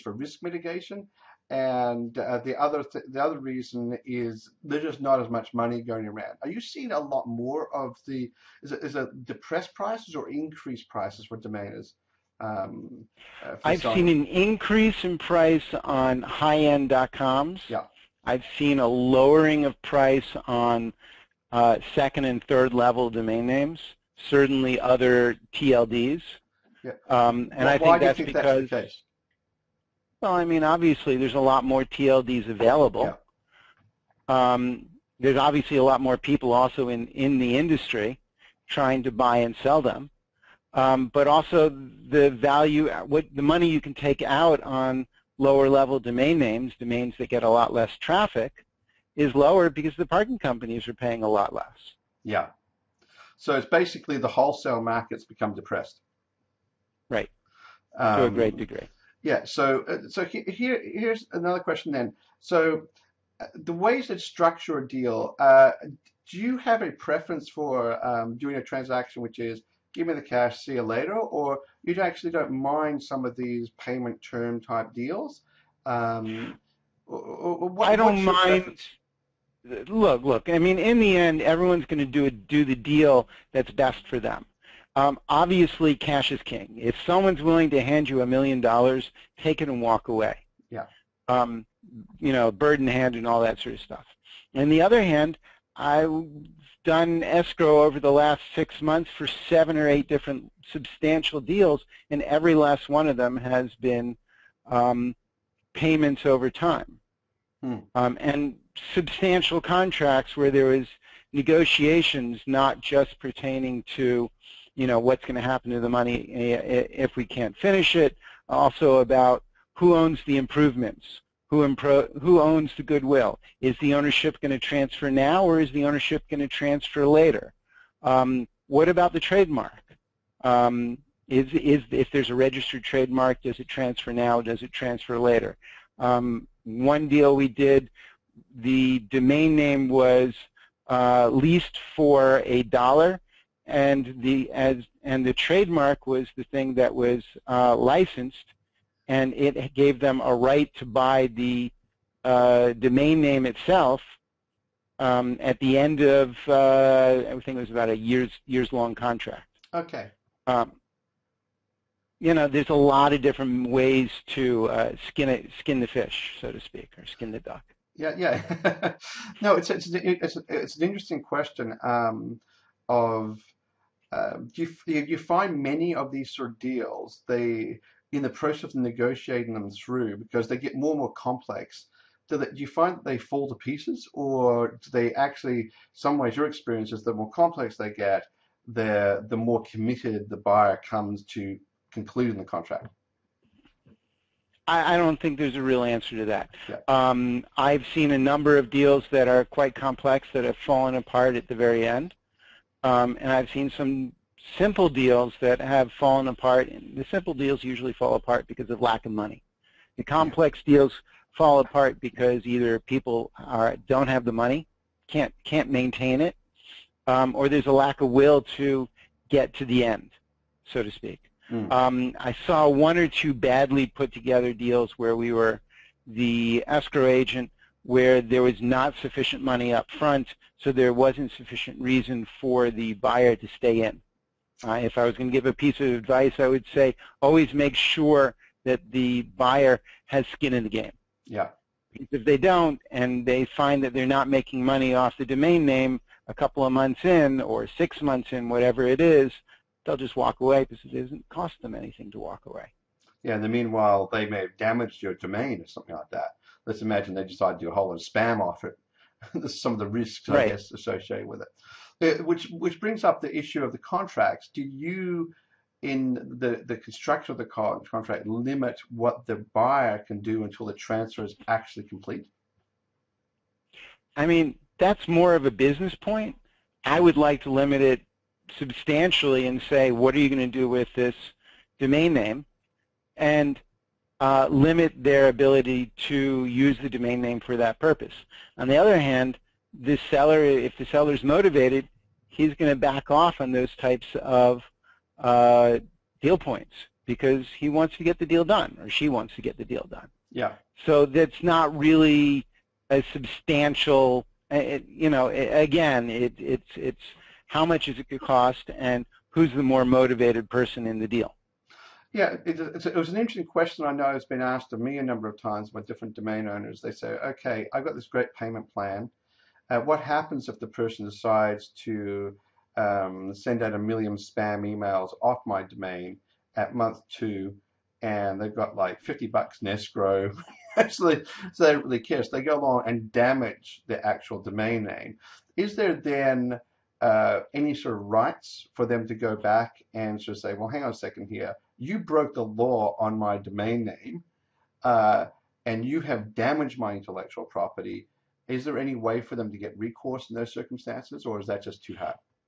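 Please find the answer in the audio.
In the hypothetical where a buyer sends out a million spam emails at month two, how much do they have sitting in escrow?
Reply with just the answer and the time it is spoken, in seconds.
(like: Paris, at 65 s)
$50, at 329 s.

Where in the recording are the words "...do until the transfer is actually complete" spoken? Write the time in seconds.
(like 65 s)
270 s.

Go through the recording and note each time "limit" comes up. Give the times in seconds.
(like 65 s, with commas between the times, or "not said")
268 s, 277 s, 284 s.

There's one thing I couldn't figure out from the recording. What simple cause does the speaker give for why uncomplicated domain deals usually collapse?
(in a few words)
lack of money.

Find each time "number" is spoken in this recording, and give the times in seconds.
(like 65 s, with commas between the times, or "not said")
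198 s, 315 s.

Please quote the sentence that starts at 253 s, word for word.
Yeah, in the meanwhile, they may have damaged your domain or something like that.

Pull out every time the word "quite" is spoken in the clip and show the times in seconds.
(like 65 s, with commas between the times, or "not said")
199 s.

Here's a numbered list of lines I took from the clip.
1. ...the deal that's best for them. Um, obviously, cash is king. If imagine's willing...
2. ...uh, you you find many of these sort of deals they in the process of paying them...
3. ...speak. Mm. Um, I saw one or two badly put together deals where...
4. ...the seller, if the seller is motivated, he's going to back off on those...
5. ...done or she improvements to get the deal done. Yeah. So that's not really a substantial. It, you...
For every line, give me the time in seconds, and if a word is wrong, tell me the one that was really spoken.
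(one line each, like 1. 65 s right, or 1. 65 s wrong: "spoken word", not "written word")
1. 82 s wrong: "someone", not "imagine"
2. 174 s wrong: "negotiating", not "paying"
3. 220 s right
4. 289 s right
5. 298 s wrong: "wants", not "improvements".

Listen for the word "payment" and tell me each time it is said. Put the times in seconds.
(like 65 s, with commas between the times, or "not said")
73 s, 105 s, 318 s.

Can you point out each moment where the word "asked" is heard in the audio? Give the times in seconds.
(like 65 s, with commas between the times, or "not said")
314 s.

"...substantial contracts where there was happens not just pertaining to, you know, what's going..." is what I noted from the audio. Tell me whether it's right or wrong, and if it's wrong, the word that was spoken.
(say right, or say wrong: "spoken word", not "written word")
wrong: "negotiations", not "happens".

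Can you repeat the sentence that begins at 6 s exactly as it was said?
Are you seeing a lot more of the is it, is it depressed prices or increased prices for domainers?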